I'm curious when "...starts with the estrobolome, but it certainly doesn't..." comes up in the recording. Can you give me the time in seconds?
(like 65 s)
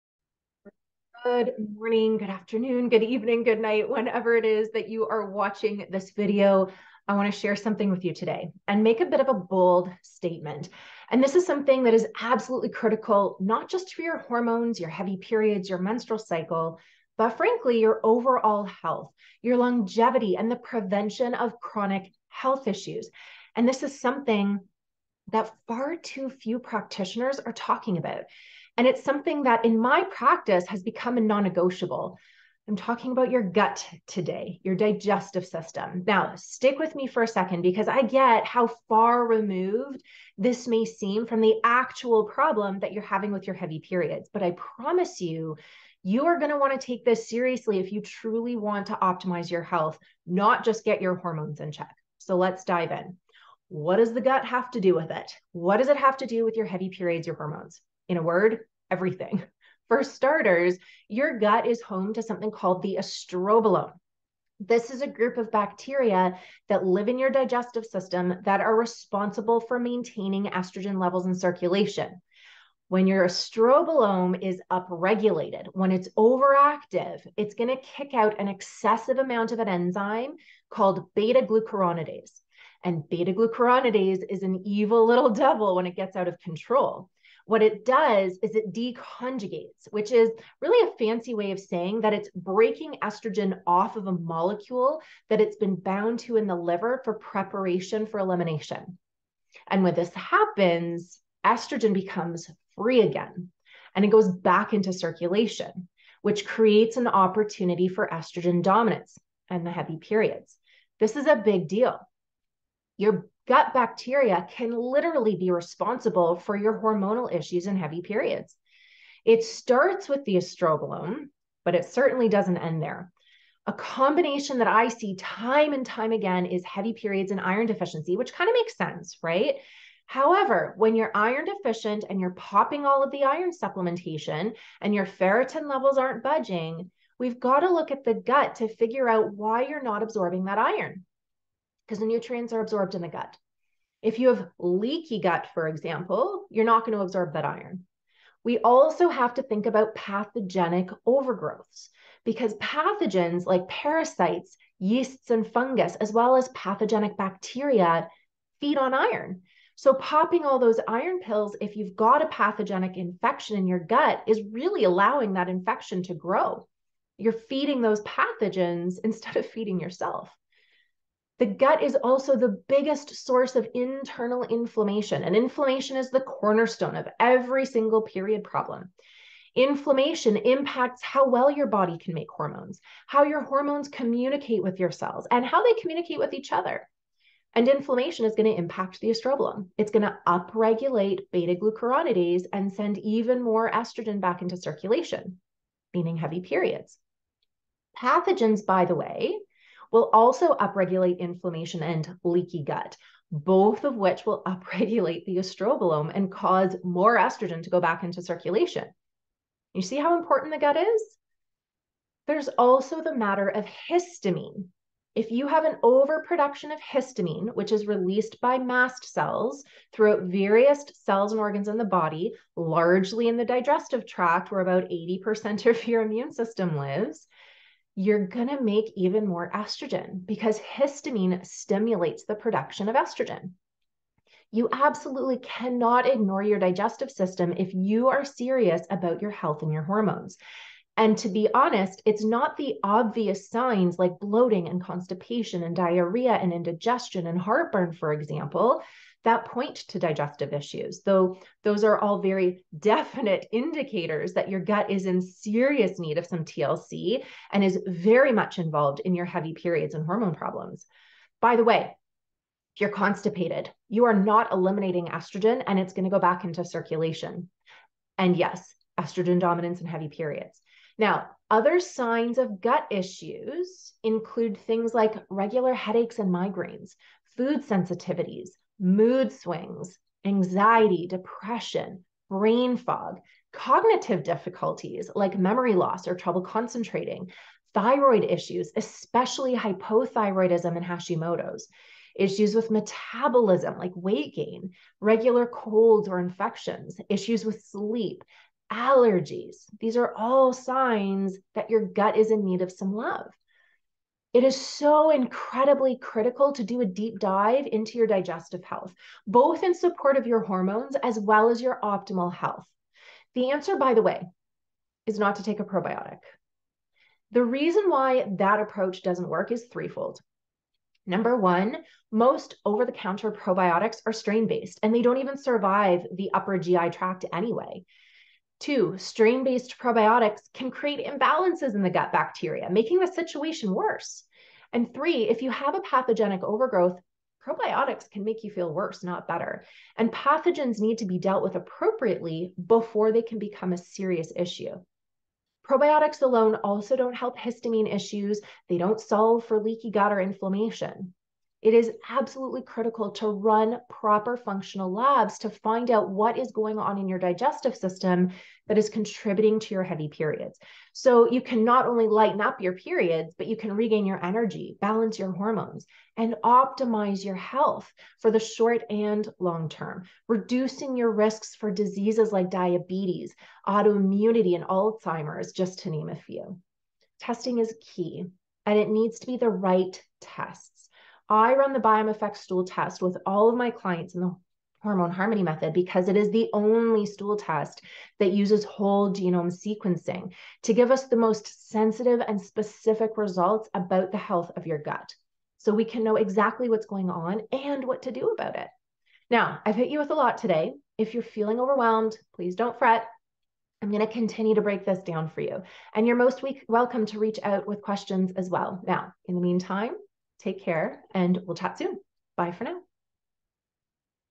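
119 s.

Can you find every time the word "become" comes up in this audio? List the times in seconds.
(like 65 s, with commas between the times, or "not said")
30 s, 101 s, 343 s.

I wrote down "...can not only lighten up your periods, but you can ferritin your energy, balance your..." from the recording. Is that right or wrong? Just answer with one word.
wrong.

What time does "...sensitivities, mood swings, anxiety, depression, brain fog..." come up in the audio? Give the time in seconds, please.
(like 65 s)
277 s.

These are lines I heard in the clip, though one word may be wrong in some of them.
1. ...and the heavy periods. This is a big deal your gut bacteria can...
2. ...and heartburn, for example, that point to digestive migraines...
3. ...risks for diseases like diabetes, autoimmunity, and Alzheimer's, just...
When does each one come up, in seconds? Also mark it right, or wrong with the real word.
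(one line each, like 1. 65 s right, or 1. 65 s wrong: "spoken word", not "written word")
1. 109 s right
2. 247 s wrong: "issues", not "migraines"
3. 371 s right.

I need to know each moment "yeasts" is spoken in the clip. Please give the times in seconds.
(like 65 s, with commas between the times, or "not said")
154 s.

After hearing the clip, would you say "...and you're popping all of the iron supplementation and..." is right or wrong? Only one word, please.
right.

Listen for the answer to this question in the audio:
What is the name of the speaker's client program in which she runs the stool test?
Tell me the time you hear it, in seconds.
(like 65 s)
384 s.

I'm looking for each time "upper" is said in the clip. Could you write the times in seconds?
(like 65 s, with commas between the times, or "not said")
326 s.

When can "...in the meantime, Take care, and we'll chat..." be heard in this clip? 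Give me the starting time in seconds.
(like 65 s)
409 s.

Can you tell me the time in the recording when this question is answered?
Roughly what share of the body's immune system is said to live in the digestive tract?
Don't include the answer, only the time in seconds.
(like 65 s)
224 s.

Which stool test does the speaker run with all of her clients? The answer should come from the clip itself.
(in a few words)
BiomeFx.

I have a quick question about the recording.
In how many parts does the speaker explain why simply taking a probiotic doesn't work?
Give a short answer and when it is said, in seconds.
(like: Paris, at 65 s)
3, at 319 s.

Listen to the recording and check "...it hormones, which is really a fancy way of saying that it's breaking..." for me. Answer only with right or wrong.
wrong.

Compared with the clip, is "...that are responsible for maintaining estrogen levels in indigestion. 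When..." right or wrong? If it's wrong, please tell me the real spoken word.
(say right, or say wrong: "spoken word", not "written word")
wrong: "circulation", not "indigestion".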